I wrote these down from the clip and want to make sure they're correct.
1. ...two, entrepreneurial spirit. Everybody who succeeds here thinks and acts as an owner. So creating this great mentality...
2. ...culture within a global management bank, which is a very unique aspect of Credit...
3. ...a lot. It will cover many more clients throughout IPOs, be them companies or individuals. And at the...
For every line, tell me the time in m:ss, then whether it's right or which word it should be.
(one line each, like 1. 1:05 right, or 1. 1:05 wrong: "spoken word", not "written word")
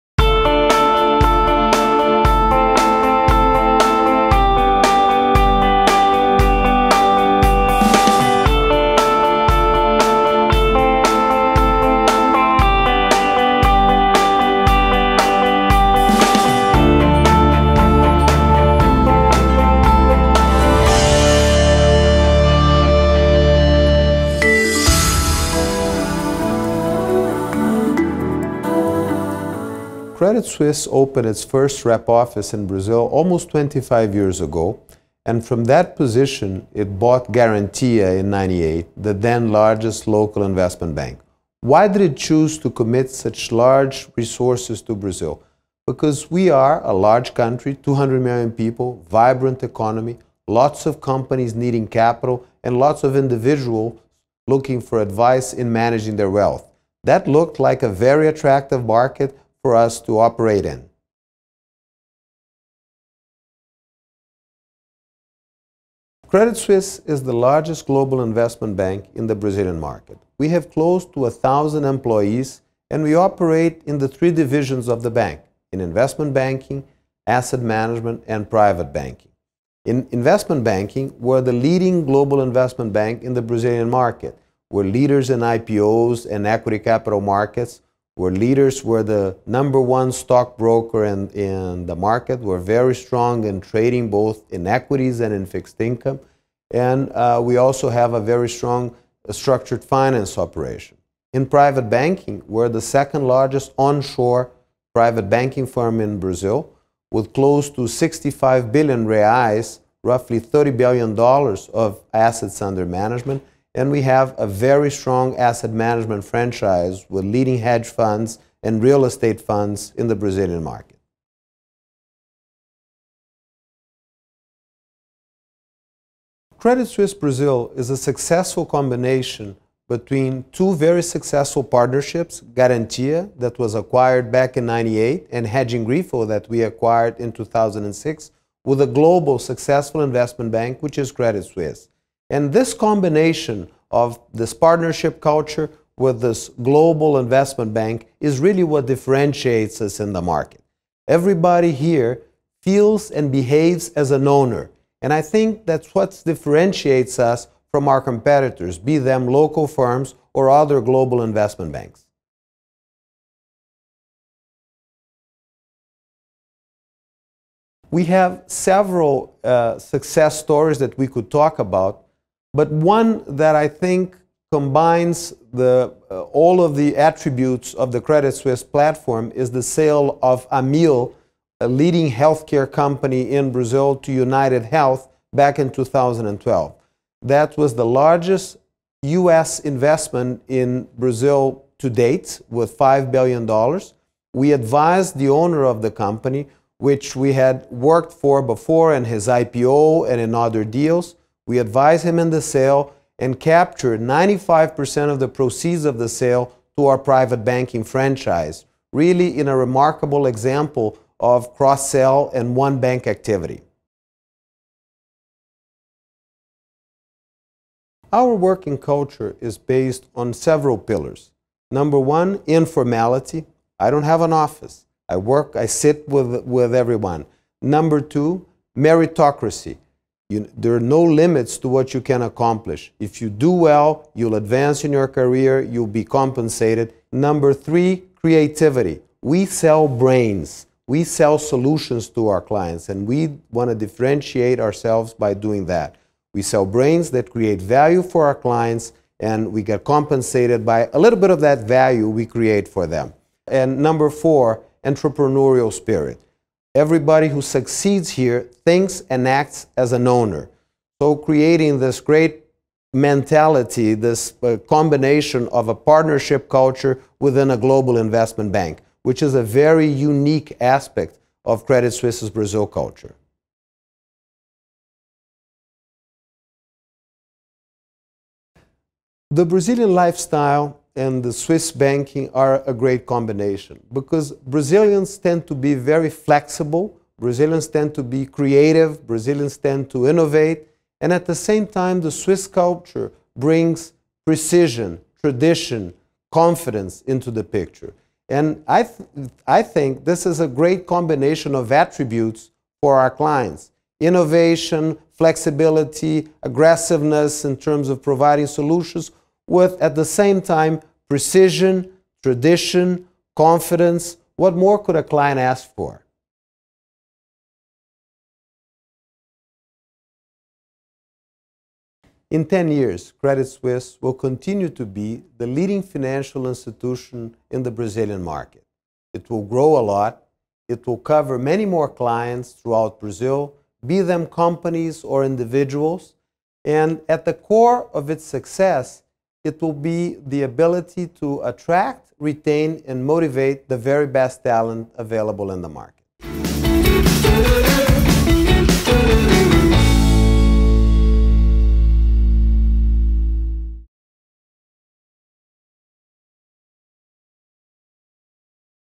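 1. 4:14 wrong: "four", not "two"
2. 4:26 wrong: "investment", not "management"
3. 5:29 wrong: "Brazil", not "IPOs".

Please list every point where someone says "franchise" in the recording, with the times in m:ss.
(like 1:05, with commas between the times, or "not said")
1:56, 3:27.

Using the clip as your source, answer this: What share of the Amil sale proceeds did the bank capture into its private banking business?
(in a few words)
95%.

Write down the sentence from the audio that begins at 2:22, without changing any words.
And this combination of this partnership culture with this global investment bank is really what differentiates us in the market.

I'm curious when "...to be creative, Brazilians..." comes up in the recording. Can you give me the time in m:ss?
4:47.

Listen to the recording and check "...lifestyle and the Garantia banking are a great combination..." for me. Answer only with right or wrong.
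wrong.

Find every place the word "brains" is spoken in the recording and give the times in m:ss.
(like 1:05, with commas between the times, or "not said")
3:59, 4:06.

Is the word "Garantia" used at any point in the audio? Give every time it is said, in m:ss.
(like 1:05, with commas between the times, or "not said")
0:37, 2:12.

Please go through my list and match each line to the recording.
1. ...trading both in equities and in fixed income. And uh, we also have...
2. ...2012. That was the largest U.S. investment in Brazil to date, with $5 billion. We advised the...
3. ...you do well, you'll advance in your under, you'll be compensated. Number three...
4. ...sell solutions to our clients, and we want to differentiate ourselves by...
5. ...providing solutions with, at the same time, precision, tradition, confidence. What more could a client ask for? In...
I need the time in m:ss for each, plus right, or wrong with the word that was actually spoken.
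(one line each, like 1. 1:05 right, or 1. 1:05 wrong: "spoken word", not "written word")
1. 1:33 right
2. 3:05 right
3. 3:53 wrong: "career", not "under"
4. 4:01 right
5. 5:08 right.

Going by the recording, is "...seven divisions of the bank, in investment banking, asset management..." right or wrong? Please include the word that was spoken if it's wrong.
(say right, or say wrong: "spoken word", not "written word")
wrong: "three", not "seven".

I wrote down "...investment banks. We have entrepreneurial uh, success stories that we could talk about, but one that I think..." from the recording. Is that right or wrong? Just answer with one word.
wrong.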